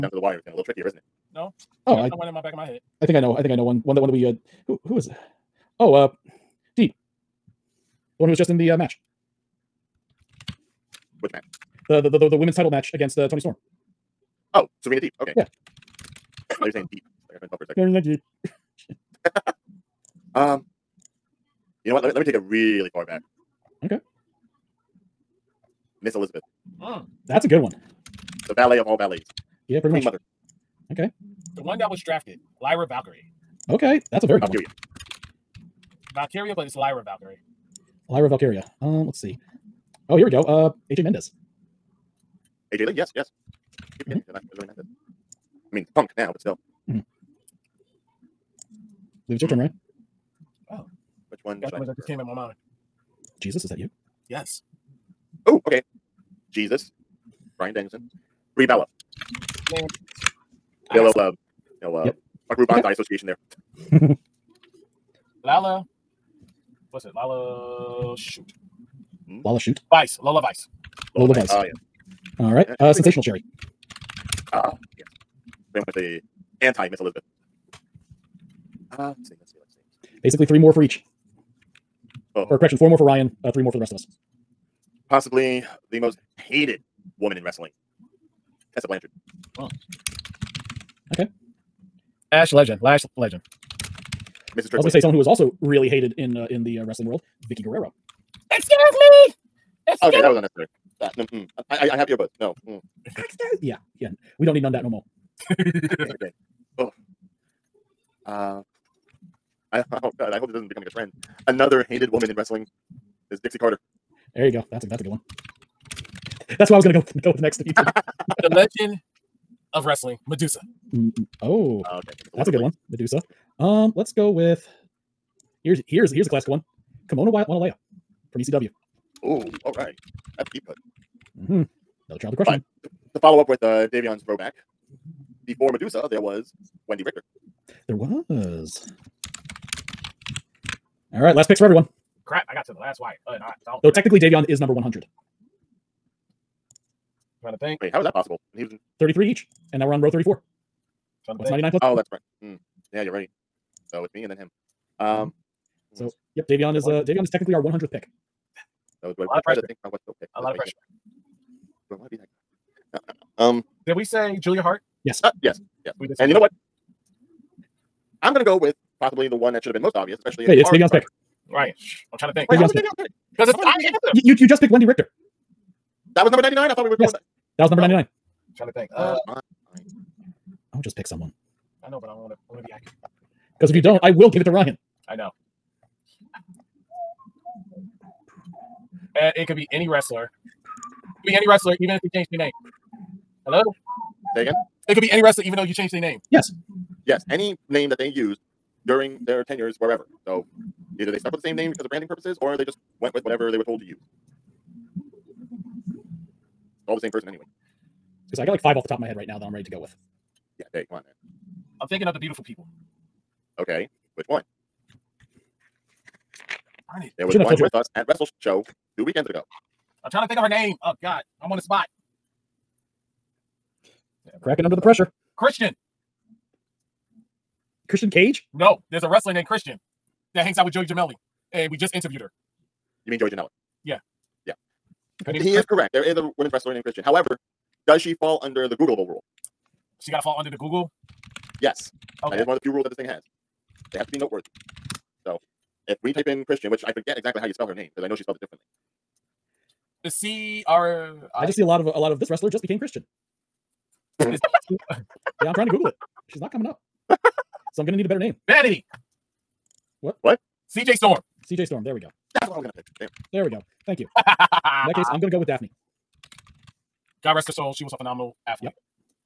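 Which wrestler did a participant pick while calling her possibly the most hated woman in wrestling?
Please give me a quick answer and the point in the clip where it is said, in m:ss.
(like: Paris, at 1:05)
Tessa Blanchard, at 1:28.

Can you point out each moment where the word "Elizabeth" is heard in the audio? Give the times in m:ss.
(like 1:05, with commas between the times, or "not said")
0:26, 1:16.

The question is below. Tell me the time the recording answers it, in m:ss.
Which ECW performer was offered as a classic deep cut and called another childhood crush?
2:07.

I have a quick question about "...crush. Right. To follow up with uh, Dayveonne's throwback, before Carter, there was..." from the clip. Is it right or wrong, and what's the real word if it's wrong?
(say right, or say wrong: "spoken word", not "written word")
wrong: "Medusa", not "Carter".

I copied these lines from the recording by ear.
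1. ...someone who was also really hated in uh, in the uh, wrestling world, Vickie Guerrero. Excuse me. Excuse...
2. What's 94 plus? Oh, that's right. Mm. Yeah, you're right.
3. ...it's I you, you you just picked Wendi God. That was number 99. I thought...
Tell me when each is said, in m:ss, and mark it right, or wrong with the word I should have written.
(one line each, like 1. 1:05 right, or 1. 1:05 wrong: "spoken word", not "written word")
1. 1:34 right
2. 2:31 wrong: "99", not "94"
3. 2:53 wrong: "Richter", not "God".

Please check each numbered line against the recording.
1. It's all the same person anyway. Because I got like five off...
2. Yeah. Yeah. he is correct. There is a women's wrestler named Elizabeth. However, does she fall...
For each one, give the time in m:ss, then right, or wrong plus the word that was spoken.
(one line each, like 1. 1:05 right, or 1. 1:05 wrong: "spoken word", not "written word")
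1. 3:24 right
2. 3:53 wrong: "Christian", not "Elizabeth".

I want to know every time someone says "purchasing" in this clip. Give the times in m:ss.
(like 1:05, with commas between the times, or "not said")
not said.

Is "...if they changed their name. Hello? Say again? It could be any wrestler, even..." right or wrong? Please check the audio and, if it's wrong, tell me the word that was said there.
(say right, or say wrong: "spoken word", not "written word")
right.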